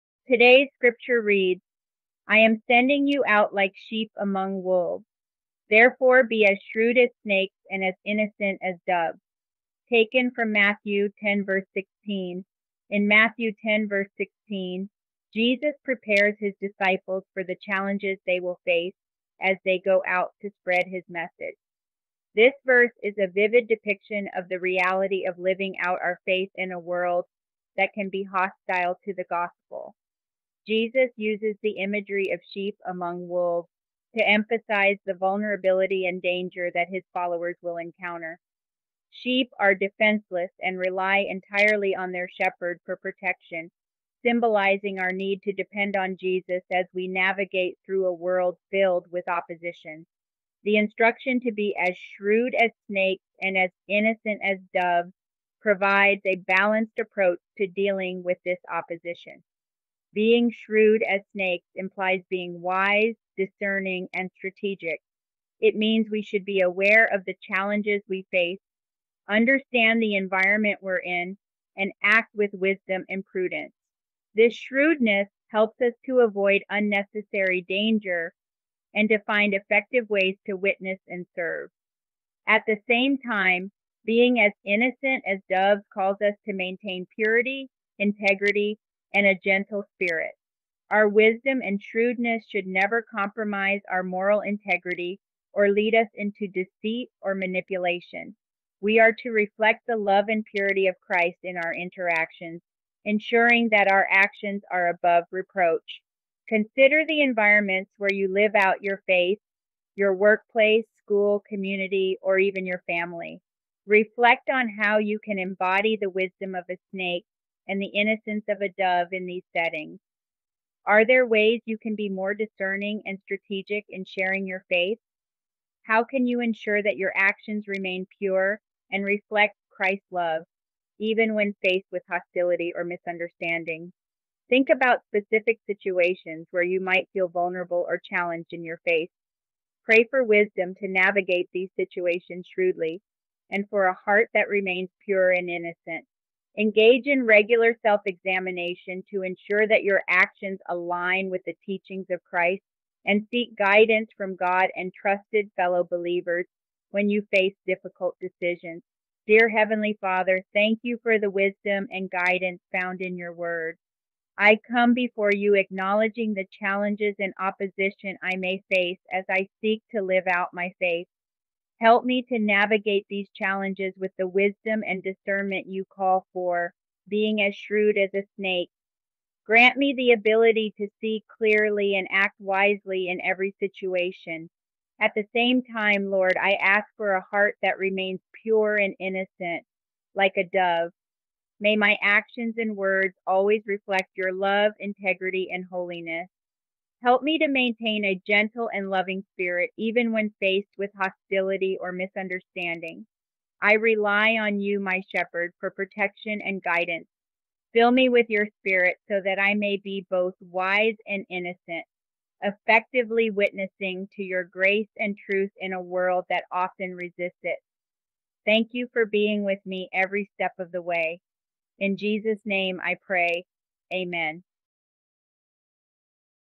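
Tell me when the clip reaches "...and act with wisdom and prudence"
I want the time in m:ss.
1:11.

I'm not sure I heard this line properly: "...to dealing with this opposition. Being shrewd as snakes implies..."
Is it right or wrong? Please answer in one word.
right.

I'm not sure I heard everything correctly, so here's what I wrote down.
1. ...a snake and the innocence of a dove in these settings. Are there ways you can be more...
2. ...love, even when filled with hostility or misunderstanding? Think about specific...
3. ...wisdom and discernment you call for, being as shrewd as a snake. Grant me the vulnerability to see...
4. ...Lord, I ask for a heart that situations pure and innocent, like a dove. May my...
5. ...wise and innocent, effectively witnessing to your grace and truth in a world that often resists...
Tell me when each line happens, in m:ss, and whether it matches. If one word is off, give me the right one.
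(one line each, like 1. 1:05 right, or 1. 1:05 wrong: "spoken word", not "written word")
1. 1:56 right
2. 2:10 wrong: "faced", not "filled"
3. 2:54 wrong: "ability", not "vulnerability"
4. 3:06 wrong: "remains", not "situations"
5. 3:30 right.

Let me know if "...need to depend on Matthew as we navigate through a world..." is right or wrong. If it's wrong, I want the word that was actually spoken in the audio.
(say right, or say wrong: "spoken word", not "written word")
wrong: "Jesus", not "Matthew".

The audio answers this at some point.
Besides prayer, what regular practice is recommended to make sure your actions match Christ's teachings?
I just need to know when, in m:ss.
2:27.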